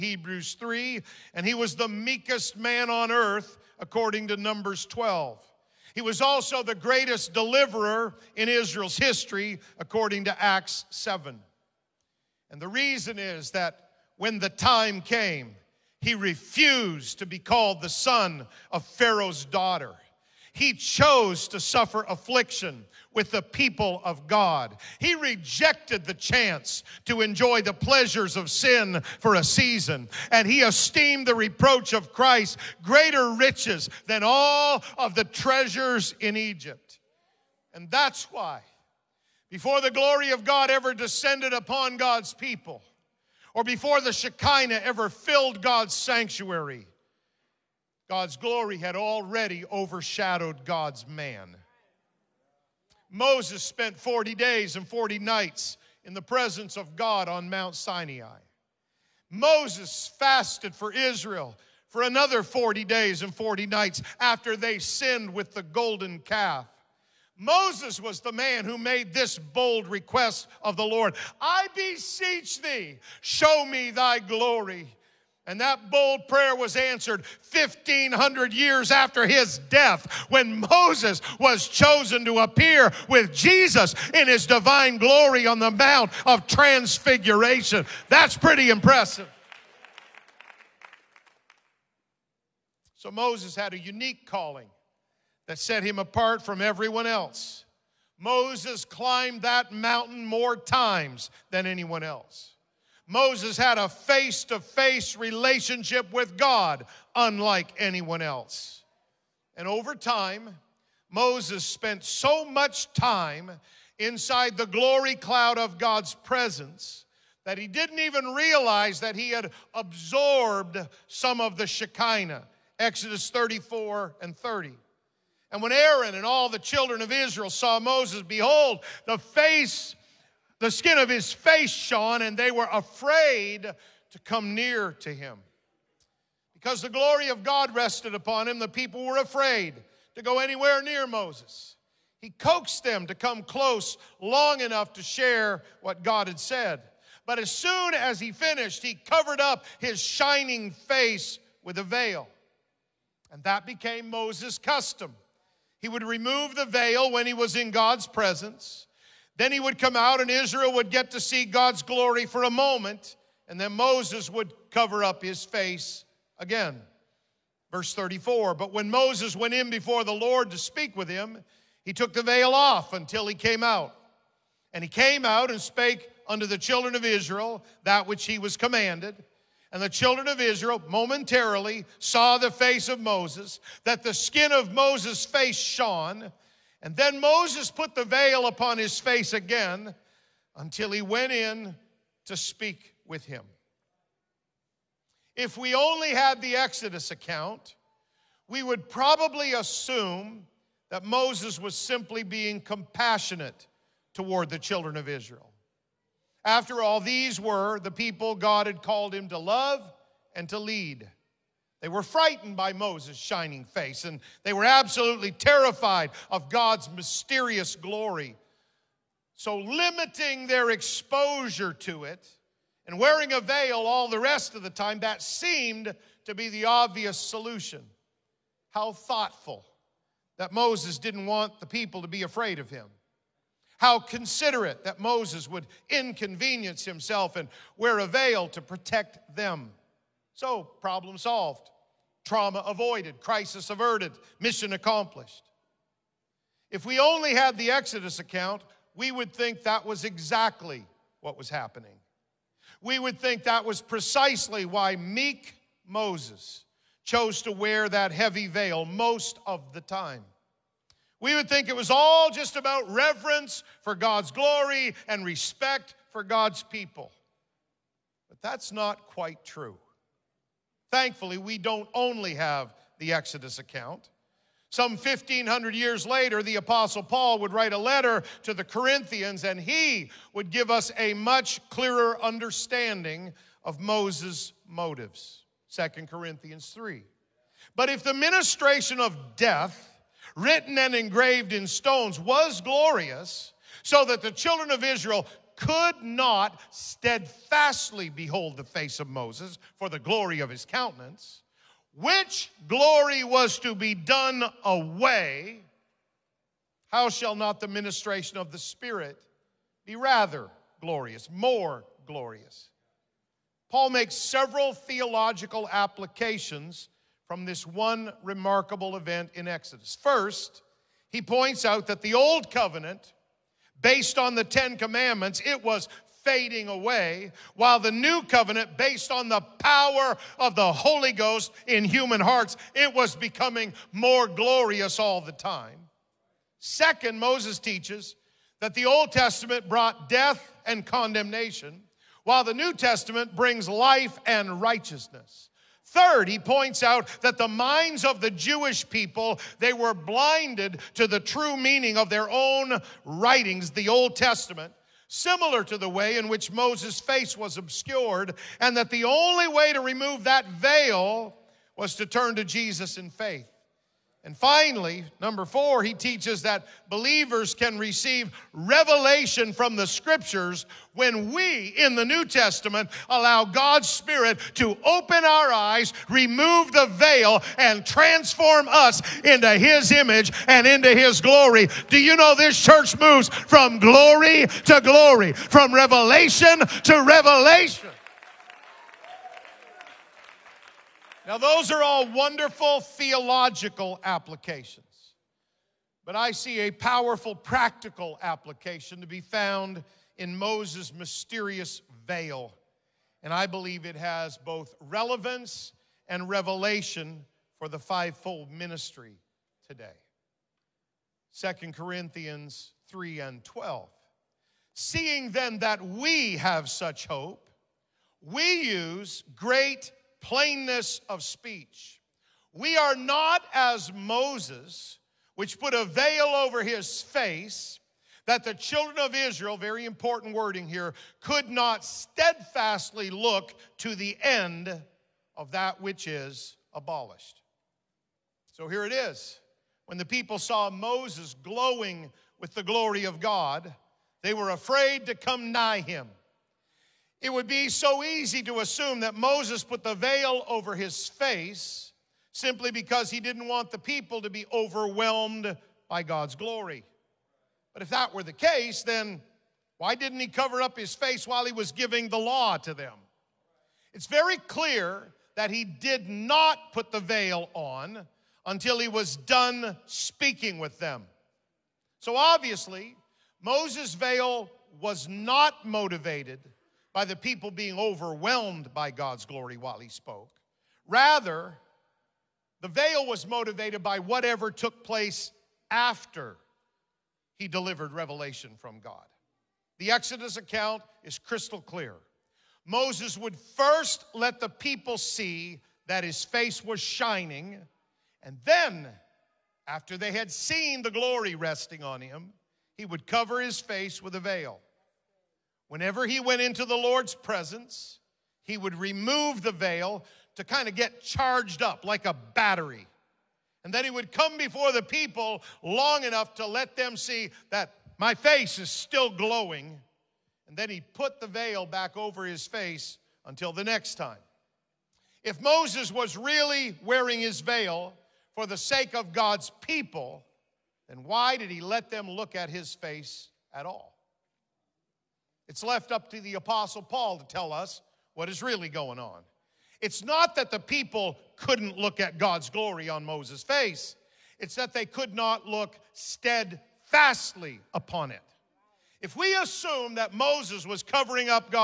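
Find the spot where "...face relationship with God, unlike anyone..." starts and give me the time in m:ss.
1:44.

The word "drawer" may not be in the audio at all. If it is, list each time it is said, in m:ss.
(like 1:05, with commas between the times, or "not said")
not said.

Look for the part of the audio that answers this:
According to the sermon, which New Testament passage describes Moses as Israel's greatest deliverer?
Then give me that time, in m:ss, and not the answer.
0:10.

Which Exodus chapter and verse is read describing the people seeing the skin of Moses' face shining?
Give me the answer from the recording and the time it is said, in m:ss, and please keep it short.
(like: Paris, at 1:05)
Exodus 34:30, at 2:03.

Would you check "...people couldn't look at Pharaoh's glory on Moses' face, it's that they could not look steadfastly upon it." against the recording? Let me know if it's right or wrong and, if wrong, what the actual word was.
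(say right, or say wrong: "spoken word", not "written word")
wrong: "God", not "Pharaoh".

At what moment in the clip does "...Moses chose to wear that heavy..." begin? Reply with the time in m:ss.
4:15.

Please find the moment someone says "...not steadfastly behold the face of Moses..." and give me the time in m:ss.
4:56.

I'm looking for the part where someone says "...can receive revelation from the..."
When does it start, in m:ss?
6:07.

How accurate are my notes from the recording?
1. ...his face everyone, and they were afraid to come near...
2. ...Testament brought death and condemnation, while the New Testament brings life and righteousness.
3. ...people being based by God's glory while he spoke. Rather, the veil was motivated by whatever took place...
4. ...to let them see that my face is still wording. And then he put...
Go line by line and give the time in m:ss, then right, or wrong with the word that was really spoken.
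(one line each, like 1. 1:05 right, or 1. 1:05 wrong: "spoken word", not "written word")
1. 2:11 wrong: "shone", not "everyone"
2. 5:39 right
3. 7:57 wrong: "overwhelmed", not "based"
4. 8:36 wrong: "glowing", not "wording".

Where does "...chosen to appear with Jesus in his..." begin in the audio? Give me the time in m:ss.
1:21.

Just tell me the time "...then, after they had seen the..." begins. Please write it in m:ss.
8:18.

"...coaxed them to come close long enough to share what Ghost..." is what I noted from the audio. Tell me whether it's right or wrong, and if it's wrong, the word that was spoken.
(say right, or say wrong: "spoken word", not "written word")
wrong: "God", not "Ghost".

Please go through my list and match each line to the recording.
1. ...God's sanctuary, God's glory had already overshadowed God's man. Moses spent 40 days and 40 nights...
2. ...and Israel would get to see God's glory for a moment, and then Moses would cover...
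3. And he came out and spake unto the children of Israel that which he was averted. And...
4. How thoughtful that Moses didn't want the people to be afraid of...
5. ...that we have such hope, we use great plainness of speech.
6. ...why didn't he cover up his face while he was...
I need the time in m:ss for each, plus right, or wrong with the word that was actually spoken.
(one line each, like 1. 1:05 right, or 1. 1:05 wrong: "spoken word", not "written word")
1. 0:45 right
2. 2:40 right
3. 2:54 wrong: "commanded", not "averted"
4. 3:48 right
5. 6:55 right
6. 7:39 right.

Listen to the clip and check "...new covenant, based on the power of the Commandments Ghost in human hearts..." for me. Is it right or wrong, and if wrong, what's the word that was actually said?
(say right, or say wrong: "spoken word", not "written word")
wrong: "Holy", not "Commandments".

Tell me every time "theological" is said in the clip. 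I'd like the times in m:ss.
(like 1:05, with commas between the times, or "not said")
5:14, 6:32.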